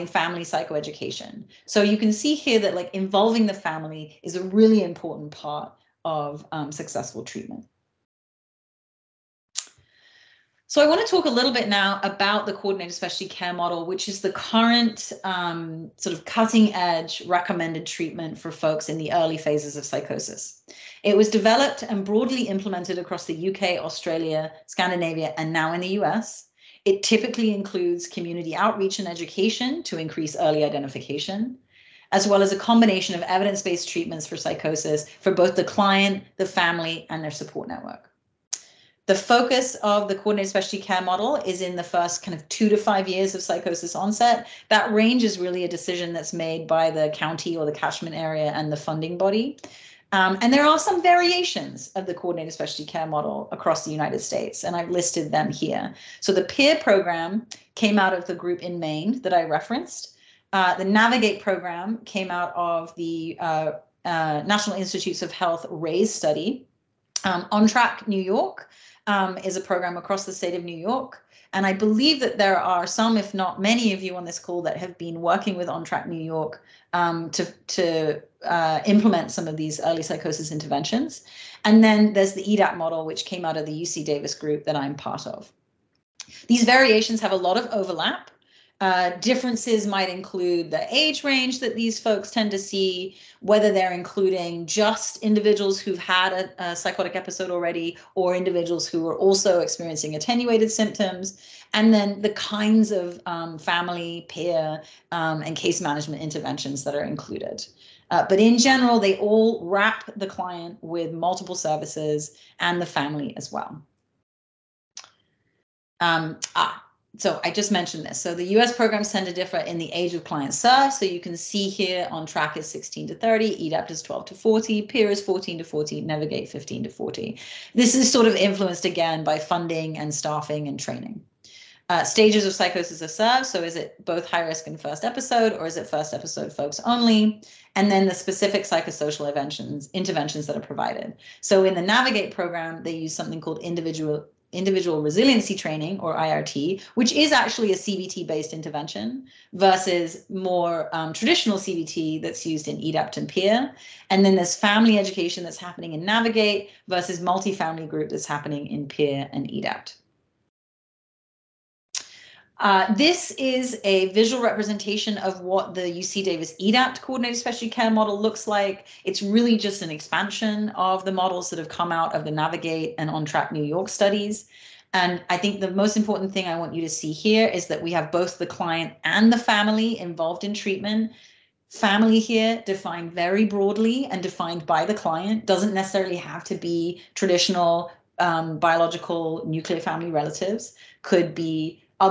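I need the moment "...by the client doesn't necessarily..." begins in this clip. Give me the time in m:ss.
3:04.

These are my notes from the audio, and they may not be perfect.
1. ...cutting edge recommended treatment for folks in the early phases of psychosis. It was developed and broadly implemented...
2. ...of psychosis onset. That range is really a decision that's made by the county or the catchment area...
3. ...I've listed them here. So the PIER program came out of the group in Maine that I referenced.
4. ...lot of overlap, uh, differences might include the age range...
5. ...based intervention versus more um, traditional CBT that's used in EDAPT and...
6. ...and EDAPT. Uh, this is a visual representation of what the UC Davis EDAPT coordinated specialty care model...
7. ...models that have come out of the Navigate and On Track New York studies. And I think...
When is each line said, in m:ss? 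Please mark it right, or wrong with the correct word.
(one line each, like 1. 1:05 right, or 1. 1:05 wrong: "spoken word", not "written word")
1. 0:16 right
2. 0:43 right
3. 0:54 right
4. 1:27 right
5. 2:28 right
6. 2:39 right
7. 2:51 right.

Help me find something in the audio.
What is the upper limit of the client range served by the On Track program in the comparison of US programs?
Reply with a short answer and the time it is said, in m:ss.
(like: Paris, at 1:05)
30, at 2:03.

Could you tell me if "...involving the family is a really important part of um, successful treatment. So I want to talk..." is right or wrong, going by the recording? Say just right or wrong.
right.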